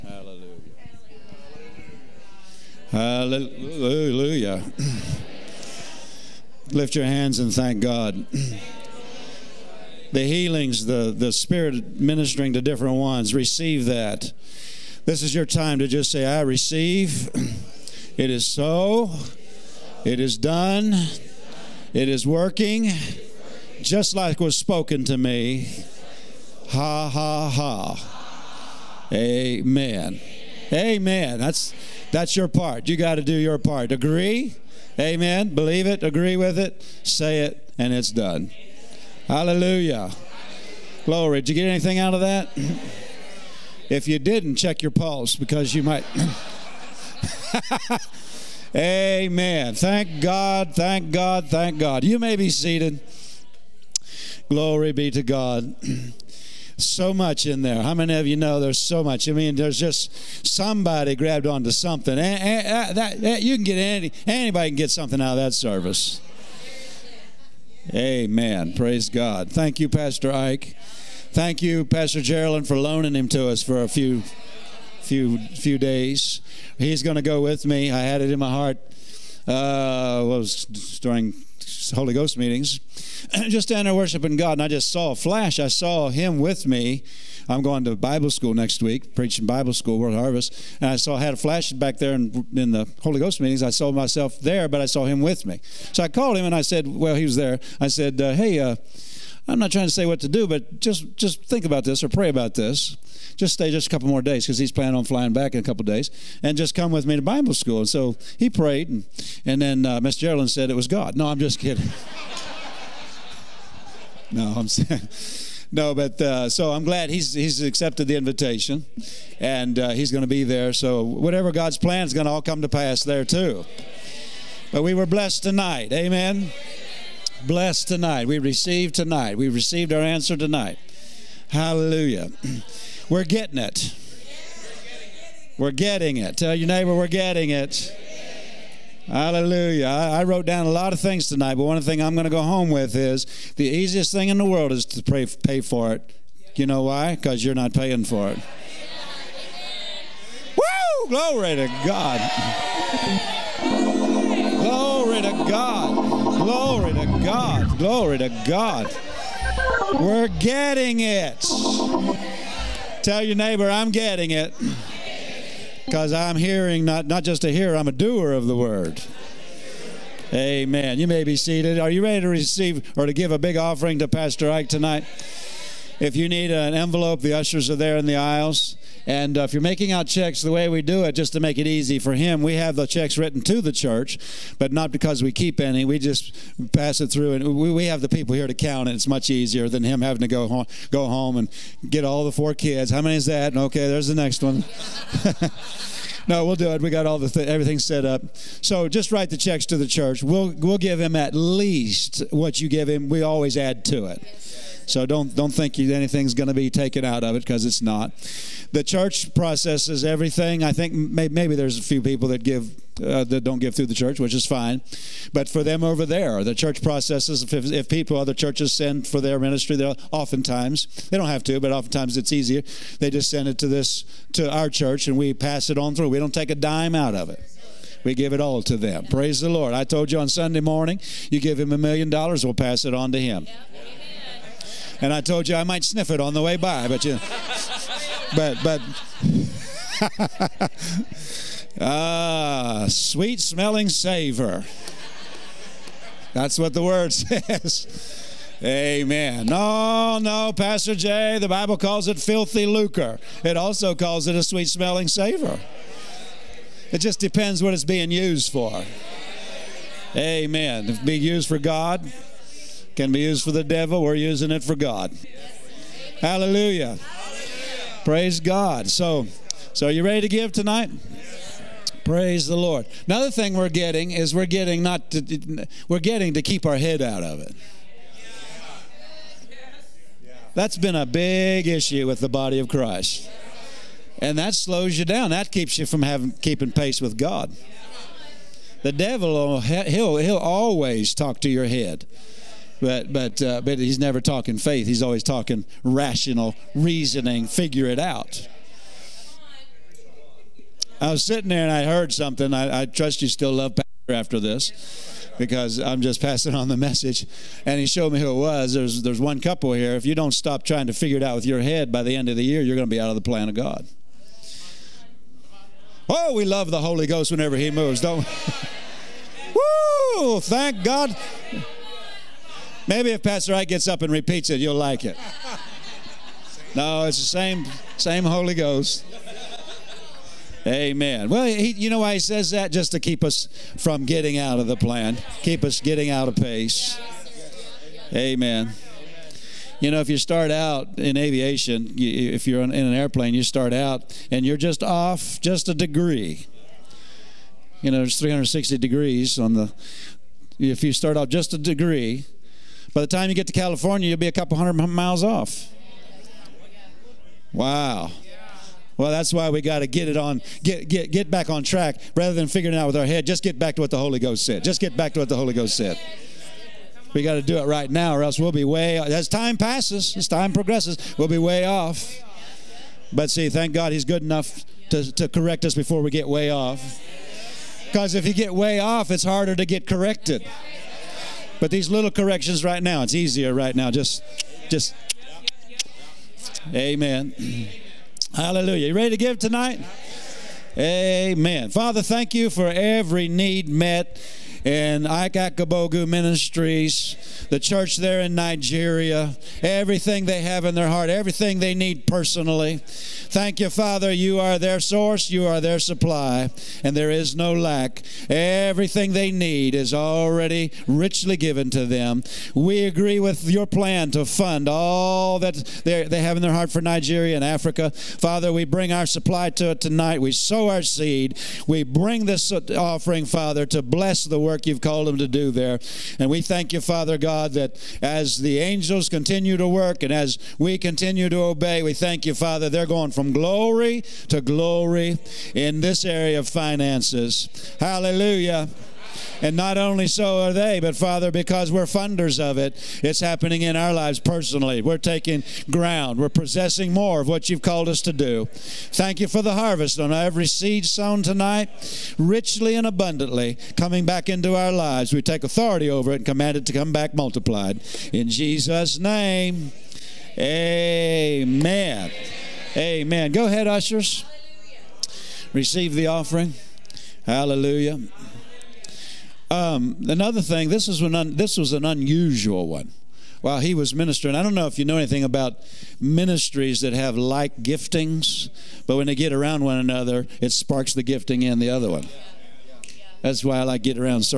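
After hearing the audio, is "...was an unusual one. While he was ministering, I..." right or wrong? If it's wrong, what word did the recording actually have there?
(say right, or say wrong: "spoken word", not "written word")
right.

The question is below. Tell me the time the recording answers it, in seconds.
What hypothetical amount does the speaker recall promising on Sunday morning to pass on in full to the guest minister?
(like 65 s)
231 s.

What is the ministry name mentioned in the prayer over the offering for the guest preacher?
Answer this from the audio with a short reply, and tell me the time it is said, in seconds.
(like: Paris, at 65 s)
Ike Akabogu Ministries, at 395 s.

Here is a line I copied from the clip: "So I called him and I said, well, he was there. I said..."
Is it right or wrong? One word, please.
right.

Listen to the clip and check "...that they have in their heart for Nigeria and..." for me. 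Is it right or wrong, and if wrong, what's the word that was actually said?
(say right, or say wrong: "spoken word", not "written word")
right.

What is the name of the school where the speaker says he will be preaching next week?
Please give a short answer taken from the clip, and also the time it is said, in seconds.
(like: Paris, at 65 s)
World Harvest, at 89 s.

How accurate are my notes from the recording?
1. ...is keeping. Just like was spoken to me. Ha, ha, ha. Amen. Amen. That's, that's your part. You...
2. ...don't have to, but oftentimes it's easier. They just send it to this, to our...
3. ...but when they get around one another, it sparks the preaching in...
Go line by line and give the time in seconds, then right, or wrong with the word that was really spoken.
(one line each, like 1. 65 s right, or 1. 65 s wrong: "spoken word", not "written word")
1. 22 s wrong: "working", not "keeping"
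2. 221 s right
3. 478 s wrong: "gifting", not "preaching".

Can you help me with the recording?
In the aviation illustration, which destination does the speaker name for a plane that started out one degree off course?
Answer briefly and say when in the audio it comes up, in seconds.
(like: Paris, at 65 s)
California, at 353 s.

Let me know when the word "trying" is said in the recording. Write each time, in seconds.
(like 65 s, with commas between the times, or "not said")
99 s, 310 s.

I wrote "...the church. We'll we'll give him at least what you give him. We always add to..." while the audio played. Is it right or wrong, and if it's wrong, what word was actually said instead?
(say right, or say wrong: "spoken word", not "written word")
right.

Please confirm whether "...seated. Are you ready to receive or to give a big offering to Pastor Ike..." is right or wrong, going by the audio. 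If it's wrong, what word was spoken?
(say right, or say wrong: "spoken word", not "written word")
right.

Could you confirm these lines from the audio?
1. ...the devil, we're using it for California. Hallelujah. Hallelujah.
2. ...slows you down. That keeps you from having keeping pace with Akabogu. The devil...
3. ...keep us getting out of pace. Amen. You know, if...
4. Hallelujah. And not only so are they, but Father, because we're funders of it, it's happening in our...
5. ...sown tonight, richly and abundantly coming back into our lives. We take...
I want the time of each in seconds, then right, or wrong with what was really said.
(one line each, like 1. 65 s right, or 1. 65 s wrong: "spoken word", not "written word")
1. 263 s wrong: "God", not "California"
2. 284 s wrong: "God", not "Akabogu"
3. 335 s right
4. 437 s right
5. 450 s right.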